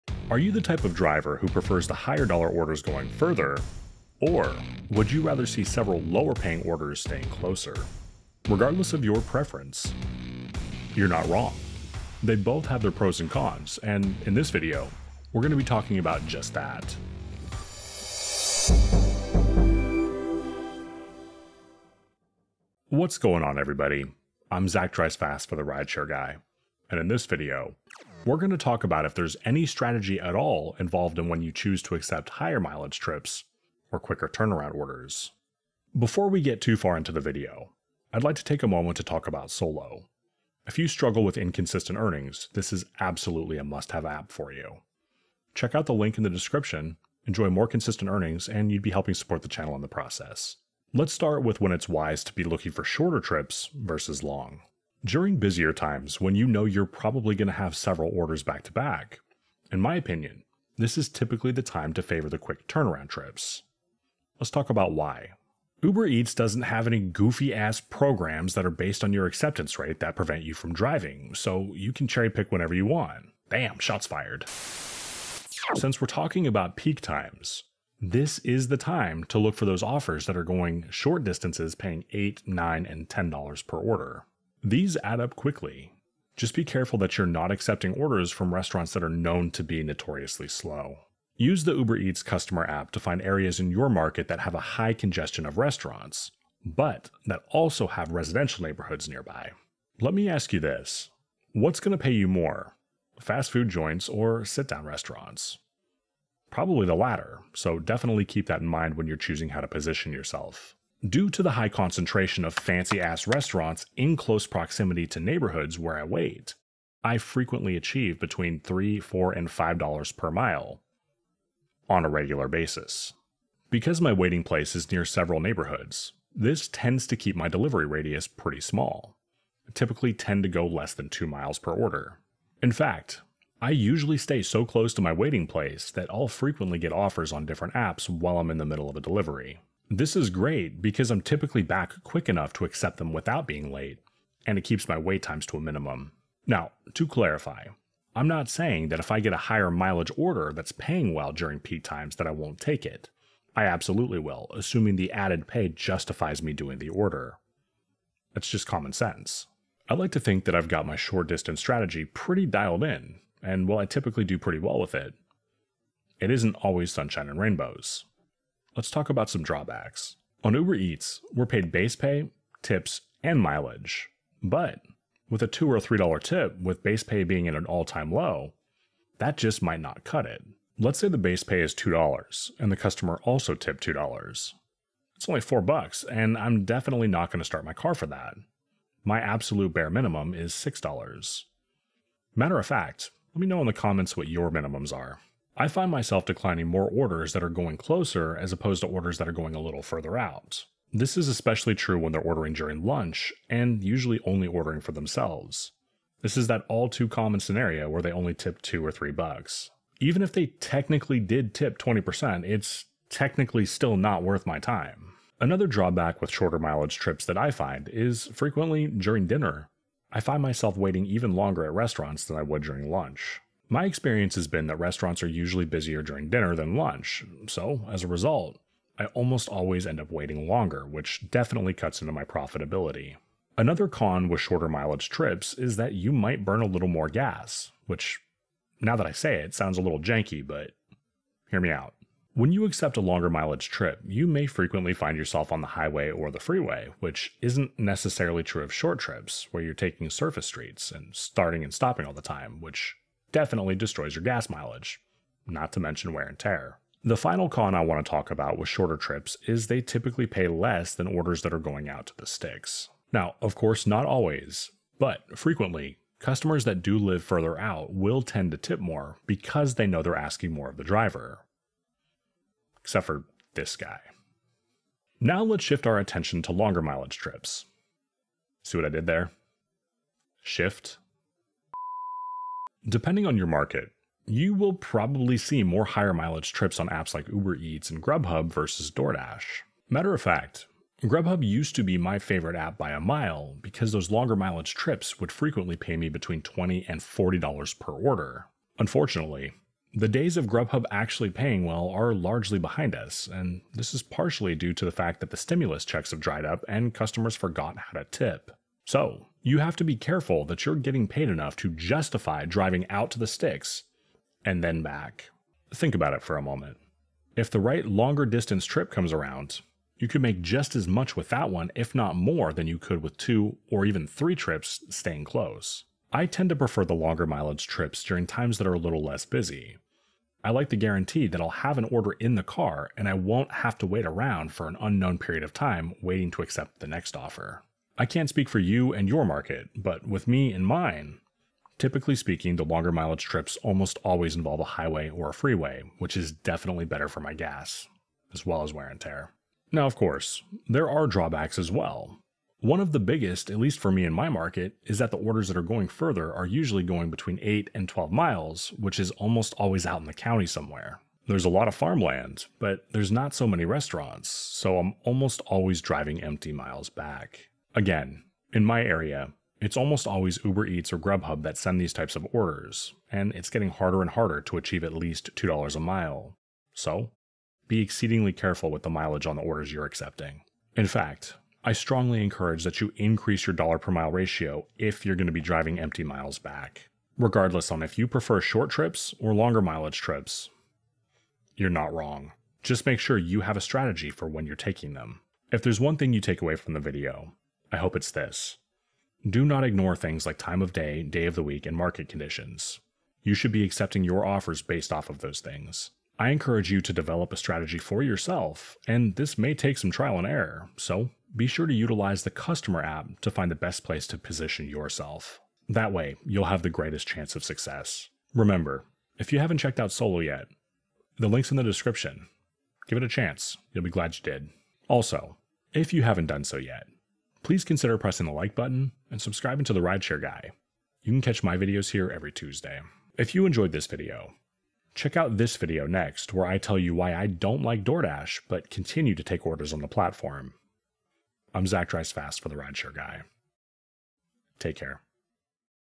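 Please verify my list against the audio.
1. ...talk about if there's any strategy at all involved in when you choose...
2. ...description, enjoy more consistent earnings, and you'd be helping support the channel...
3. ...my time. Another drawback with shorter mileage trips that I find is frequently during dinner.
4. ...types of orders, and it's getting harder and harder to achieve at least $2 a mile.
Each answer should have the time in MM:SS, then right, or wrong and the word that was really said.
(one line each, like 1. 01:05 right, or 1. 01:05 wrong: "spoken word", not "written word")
1. 00:28 right
2. 00:46 right
3. 03:34 right
4. 06:11 right.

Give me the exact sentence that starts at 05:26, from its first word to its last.
I tend to prefer the longer mileage trips during times that are a little less busy.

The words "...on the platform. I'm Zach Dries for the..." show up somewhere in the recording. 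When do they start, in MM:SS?
07:19.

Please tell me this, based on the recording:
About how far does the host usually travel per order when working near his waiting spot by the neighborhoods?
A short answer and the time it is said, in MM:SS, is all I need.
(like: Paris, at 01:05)
less than 2 miles, at 02:10.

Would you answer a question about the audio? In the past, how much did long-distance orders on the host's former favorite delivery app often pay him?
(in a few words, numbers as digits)
$20 to $40.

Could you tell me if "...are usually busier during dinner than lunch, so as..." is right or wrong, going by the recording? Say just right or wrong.
right.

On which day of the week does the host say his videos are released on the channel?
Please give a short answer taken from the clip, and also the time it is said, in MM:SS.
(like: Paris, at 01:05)
Tuesday, at 07:12.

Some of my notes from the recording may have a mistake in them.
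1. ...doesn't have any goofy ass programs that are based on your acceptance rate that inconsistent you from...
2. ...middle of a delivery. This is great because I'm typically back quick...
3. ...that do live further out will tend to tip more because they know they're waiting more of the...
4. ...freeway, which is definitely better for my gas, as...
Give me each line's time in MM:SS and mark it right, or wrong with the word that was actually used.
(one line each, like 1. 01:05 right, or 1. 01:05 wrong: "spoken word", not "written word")
1. 01:06 wrong: "prevent", not "inconsistent"
2. 02:18 right
3. 04:26 wrong: "asking", not "waiting"
4. 05:45 right.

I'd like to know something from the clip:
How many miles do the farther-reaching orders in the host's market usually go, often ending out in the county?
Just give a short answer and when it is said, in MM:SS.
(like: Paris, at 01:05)
8 to 12 miles, at 05:57.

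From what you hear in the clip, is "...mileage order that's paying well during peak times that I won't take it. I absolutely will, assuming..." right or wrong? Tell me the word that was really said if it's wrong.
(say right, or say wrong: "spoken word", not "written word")
right.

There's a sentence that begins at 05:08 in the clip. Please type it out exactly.
So, you have to be careful that you're getting paid enough to justify driving out to the sticks and then back.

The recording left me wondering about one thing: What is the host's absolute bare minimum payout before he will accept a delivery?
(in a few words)
$6.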